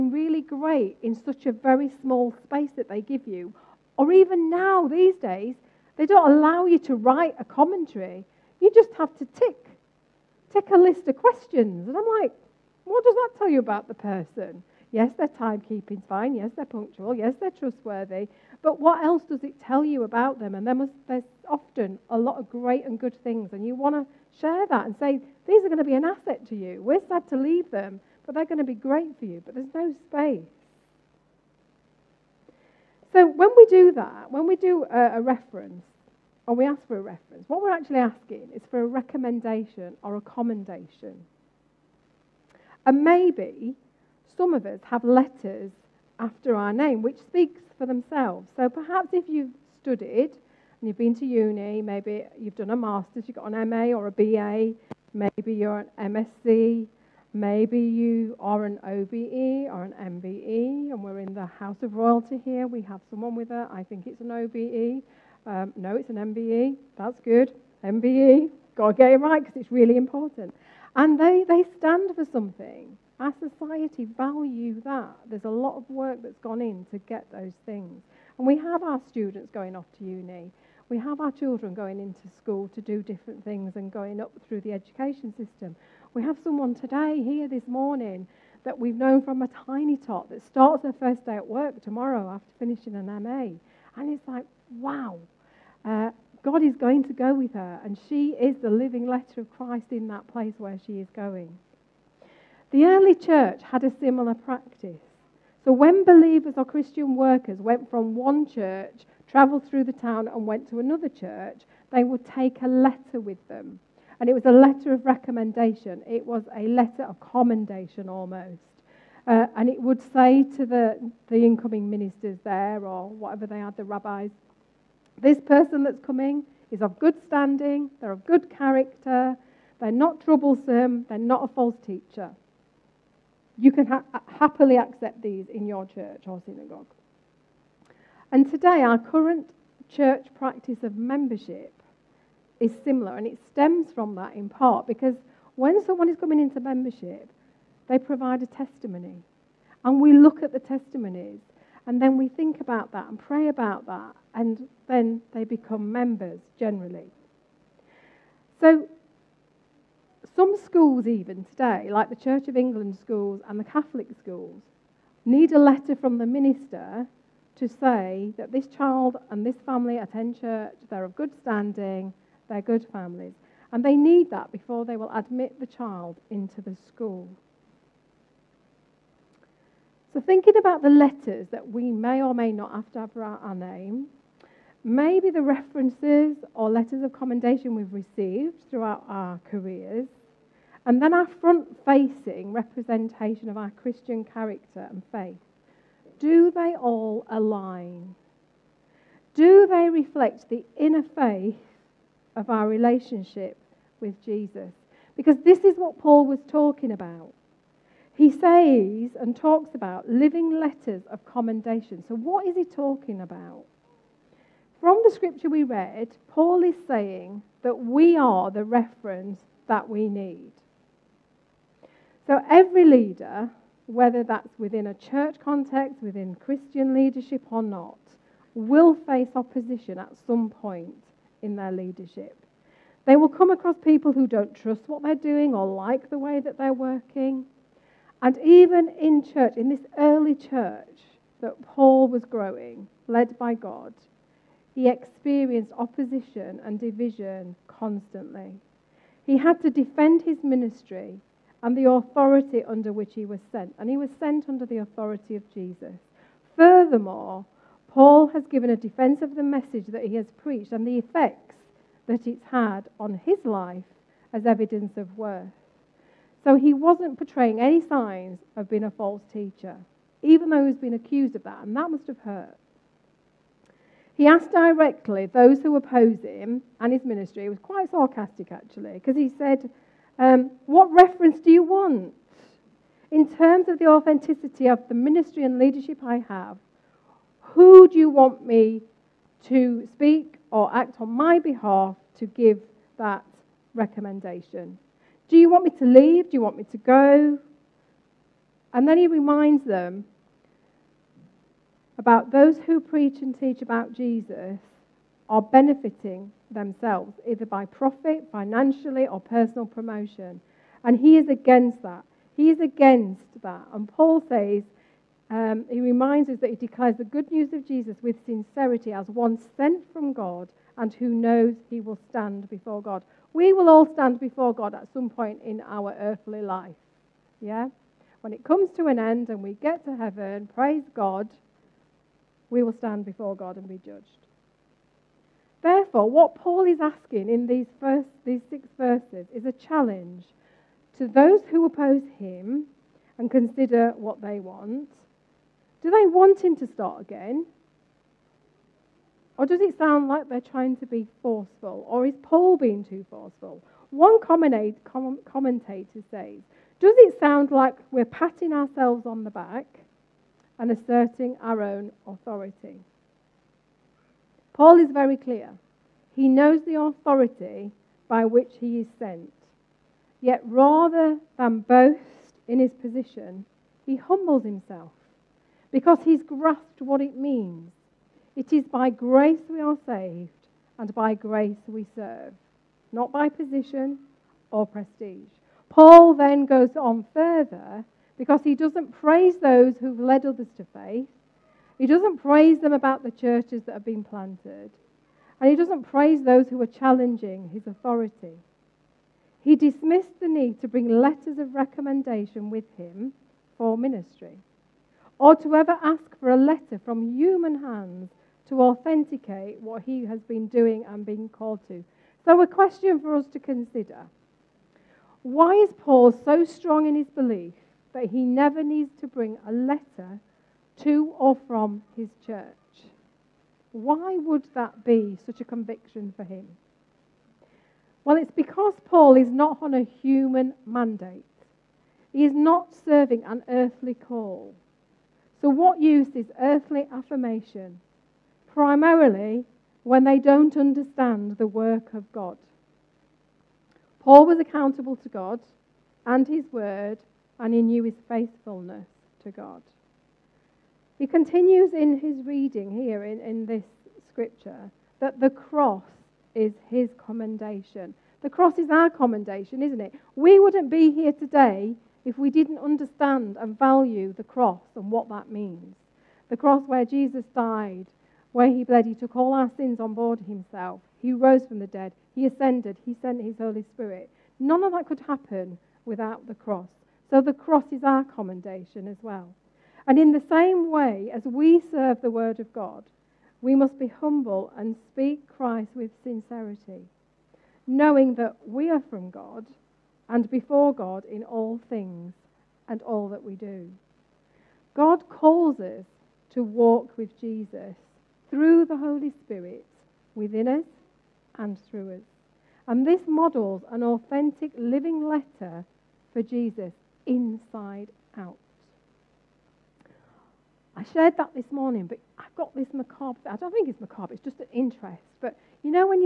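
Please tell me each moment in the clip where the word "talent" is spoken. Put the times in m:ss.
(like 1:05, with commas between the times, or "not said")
not said.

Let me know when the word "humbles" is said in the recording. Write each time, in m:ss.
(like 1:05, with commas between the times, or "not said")
6:13, 8:03.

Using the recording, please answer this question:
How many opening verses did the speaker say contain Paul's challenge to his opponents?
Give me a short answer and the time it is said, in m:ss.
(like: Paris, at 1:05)
6, at 5:38.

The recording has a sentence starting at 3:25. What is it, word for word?
Because this is what Paul was talking about.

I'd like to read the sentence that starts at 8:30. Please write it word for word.
I shared that this morning, but I've got this macabre.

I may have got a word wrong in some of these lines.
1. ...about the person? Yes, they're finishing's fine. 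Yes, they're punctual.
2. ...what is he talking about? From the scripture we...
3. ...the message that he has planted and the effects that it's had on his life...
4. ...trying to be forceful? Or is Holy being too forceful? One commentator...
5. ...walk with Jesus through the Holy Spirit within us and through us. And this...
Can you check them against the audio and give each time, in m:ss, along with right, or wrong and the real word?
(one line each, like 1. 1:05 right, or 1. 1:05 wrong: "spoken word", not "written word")
1. 0:13 wrong: "timekeeping", not "finishing"
2. 3:32 right
3. 4:19 wrong: "preached", not "planted"
4. 5:50 wrong: "Paul", not "Holy"
5. 8:16 right.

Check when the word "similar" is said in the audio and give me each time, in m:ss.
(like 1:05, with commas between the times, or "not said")
1:43, 2:22.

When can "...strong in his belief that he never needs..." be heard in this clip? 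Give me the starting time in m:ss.
6:56.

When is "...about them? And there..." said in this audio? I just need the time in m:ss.
0:20.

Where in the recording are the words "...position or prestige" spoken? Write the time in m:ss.
6:23.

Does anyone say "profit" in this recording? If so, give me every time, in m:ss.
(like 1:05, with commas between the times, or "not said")
5:07.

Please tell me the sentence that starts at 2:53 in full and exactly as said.
And they need that before they will admit the child into the school.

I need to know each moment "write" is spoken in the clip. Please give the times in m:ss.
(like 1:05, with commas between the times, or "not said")
0:06.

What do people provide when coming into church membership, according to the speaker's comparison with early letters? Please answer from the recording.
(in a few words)
A testimony.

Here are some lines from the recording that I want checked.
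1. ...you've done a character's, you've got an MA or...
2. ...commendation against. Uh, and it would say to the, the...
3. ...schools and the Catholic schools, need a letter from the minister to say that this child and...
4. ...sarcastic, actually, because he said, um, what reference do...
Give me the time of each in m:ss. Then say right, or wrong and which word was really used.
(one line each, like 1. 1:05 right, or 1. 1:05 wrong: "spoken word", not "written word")
1. 0:52 wrong: "master", not "character"
2. 1:57 wrong: "almost", not "against"
3. 2:42 right
4. 4:37 right.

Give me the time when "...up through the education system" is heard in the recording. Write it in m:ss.
1:24.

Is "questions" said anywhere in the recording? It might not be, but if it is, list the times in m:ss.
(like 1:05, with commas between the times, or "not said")
0:11, 6:52.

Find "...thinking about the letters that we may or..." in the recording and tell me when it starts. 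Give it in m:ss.
3:00.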